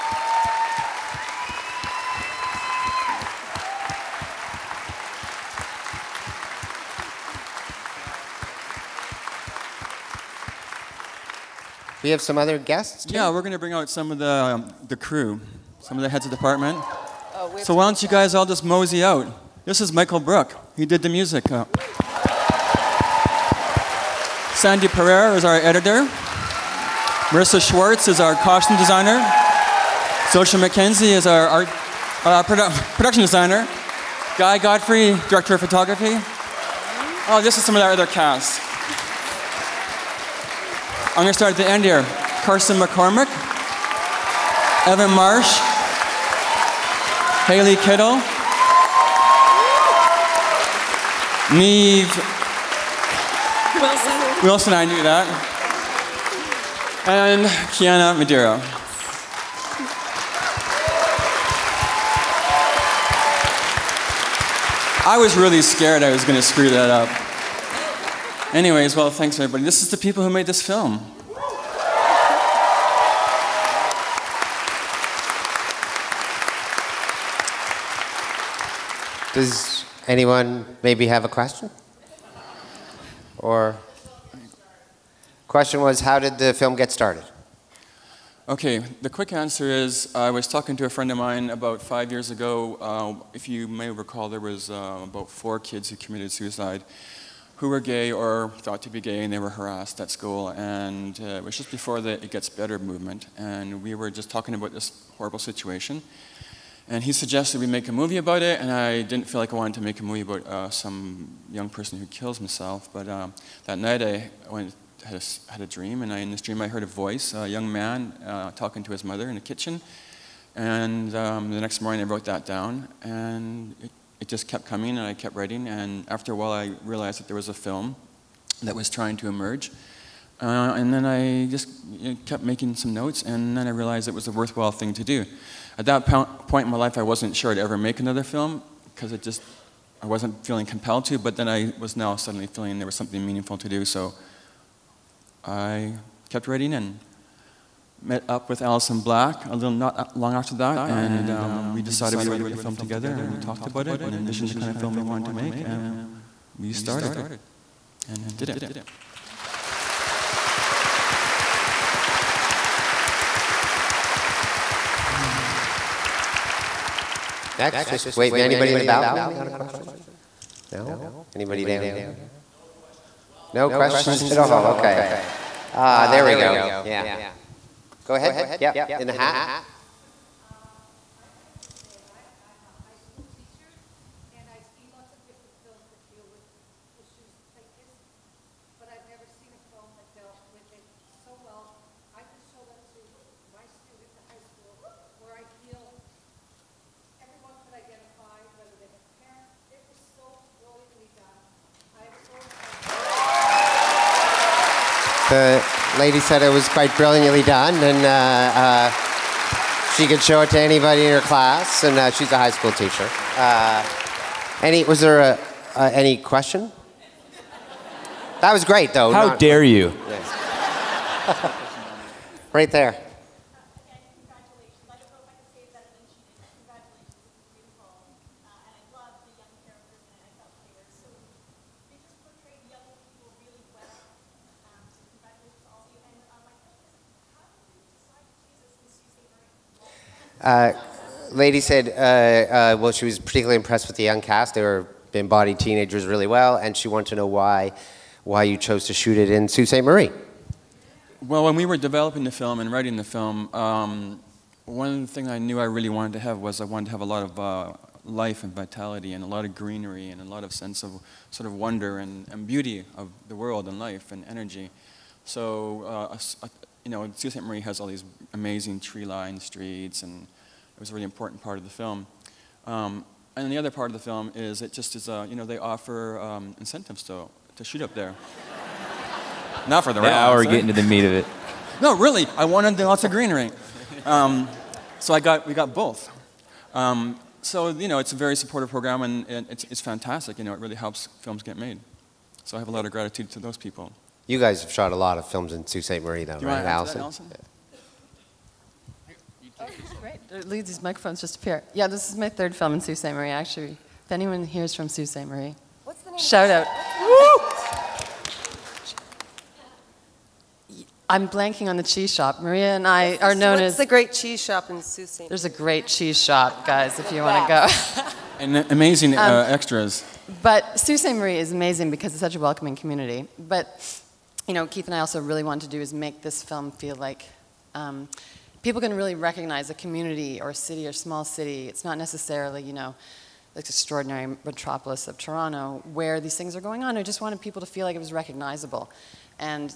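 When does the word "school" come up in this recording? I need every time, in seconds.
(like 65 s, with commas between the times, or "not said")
100 s, 212 s.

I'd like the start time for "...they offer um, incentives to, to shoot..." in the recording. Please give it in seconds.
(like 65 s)
275 s.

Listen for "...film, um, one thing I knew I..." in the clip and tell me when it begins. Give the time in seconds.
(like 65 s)
253 s.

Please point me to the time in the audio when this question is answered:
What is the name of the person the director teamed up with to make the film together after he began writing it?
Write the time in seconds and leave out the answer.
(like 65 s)
148 s.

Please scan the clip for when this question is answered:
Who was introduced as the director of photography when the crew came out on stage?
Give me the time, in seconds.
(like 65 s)
34 s.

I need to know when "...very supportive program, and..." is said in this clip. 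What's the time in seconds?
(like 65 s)
288 s.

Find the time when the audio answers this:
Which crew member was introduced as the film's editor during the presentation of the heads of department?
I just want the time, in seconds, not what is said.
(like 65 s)
24 s.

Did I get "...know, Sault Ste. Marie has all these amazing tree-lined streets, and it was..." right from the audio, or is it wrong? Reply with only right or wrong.
right.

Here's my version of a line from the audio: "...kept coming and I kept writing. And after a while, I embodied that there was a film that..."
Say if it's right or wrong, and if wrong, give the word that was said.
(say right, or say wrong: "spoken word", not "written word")
wrong: "realized", not "embodied".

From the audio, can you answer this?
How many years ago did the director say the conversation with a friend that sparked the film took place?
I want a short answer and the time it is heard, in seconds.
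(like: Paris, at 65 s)
5, at 91 s.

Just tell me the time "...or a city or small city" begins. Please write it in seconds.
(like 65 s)
330 s.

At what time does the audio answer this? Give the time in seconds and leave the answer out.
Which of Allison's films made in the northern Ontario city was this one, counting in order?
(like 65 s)
302 s.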